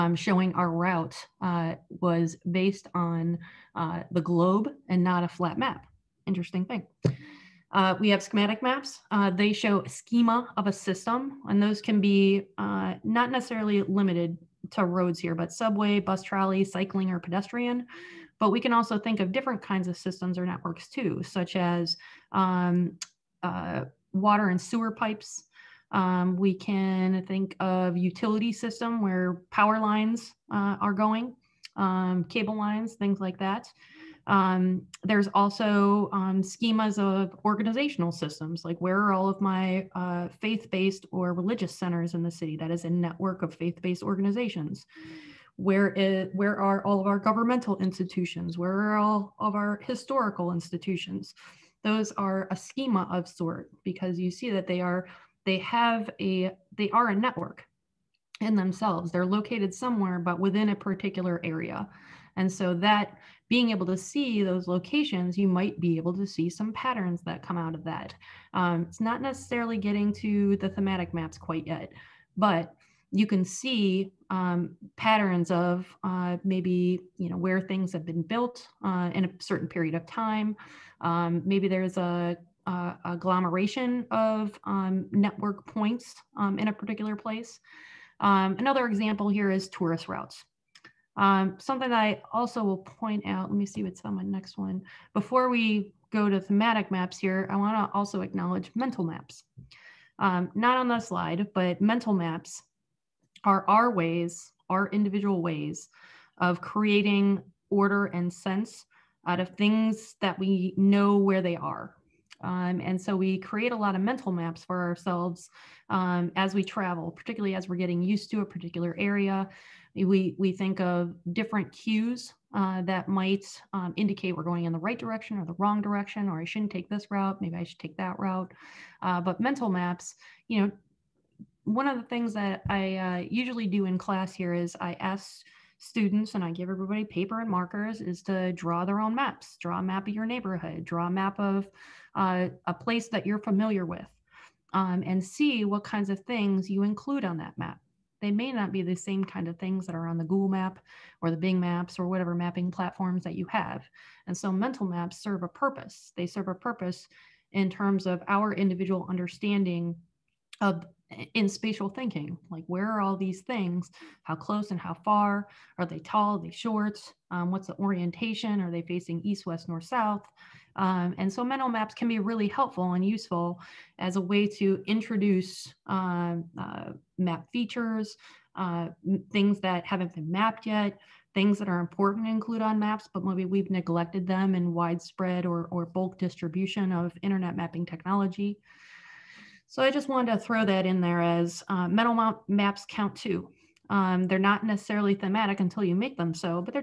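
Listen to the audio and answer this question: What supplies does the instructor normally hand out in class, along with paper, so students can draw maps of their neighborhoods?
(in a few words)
Markers.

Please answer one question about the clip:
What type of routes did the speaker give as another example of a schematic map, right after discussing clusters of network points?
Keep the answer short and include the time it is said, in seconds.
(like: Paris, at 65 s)
Tourist routes, at 89 s.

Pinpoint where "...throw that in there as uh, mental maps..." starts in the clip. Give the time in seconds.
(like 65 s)
190 s.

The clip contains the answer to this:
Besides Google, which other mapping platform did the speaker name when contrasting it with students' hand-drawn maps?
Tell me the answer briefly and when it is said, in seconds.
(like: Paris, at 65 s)
Bing, at 151 s.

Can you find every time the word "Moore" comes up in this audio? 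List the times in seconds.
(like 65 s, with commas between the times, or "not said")
not said.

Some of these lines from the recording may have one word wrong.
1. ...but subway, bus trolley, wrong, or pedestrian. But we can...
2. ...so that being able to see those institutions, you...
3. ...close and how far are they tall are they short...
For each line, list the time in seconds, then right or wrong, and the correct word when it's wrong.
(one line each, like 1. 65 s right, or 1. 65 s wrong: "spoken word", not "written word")
1. 15 s wrong: "cycling", not "wrong"
2. 62 s wrong: "locations", not "institutions"
3. 164 s right.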